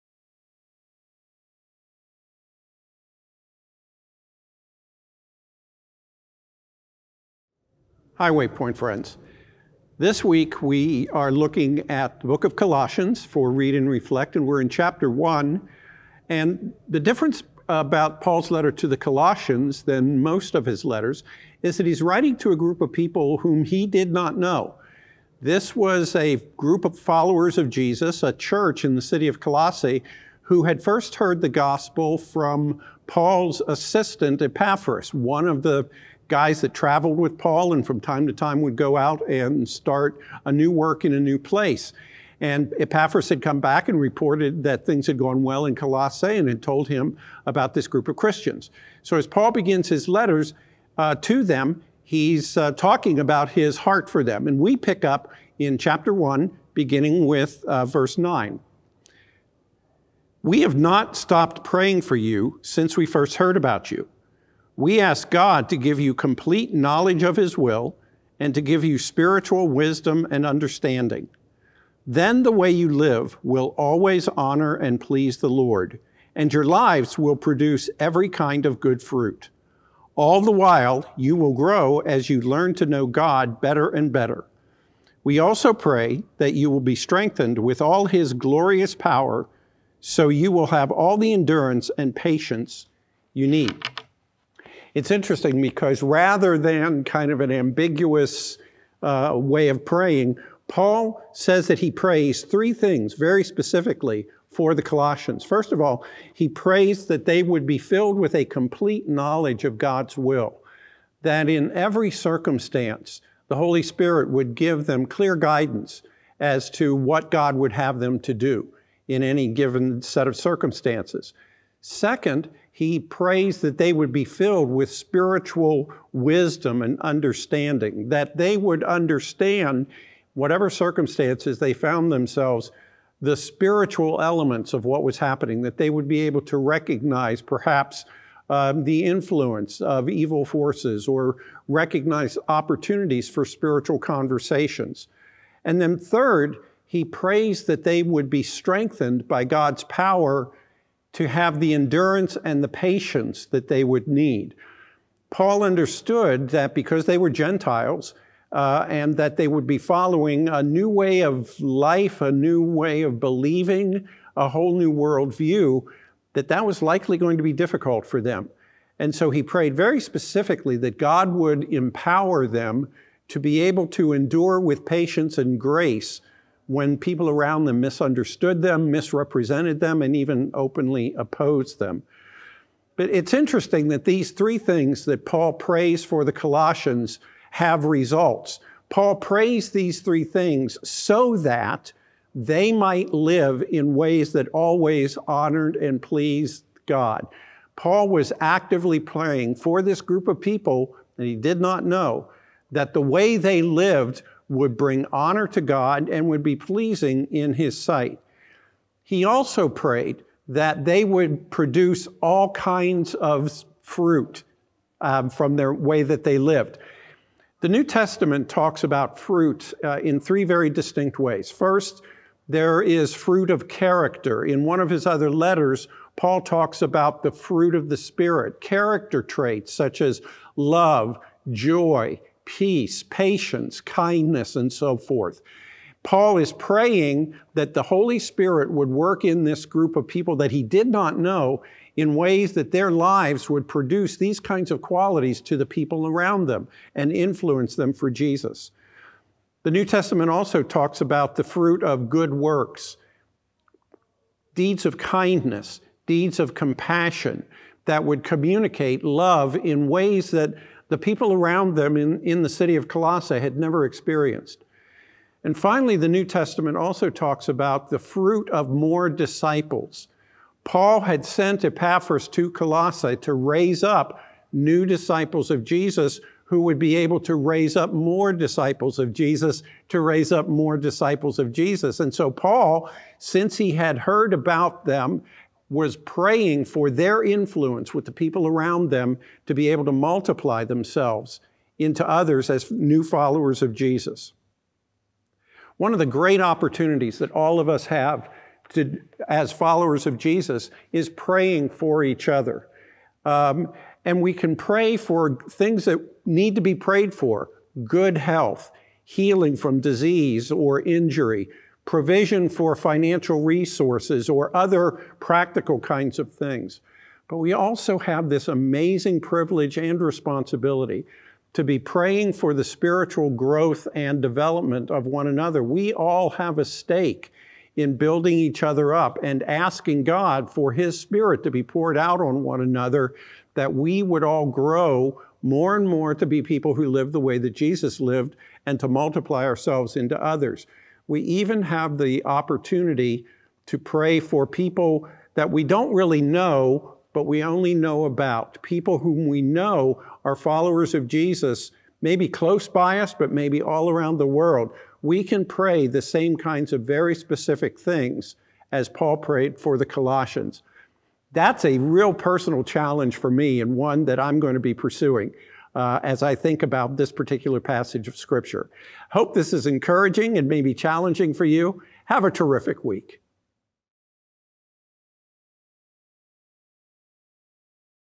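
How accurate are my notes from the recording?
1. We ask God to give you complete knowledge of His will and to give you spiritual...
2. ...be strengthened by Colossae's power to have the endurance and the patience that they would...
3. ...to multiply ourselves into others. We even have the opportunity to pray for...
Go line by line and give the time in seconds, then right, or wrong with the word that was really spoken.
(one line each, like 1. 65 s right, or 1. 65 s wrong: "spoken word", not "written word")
1. 64 s right
2. 148 s wrong: "God", not "Colossae"
3. 338 s right.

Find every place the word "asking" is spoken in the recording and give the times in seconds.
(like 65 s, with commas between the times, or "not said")
329 s.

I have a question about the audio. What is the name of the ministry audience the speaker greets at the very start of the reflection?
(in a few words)
Waypoint.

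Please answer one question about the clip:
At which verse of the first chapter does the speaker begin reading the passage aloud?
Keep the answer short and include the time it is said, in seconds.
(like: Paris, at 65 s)
9, at 57 s.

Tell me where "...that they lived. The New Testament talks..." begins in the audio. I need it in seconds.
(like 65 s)
216 s.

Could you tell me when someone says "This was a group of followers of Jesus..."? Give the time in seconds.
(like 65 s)
25 s.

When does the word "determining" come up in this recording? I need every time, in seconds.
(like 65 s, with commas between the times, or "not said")
not said.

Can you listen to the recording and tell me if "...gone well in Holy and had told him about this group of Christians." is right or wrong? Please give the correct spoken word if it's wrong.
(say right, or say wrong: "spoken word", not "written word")
wrong: "Colossae", not "Holy".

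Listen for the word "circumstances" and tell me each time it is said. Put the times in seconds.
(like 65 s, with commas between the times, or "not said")
112 s, 120 s, 130 s.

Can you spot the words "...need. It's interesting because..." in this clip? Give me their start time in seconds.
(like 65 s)
93 s.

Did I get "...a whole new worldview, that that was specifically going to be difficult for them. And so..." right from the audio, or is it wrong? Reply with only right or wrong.
wrong.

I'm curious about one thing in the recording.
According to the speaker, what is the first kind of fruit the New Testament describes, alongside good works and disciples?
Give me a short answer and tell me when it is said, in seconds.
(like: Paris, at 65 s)
fruit of character, at 223 s.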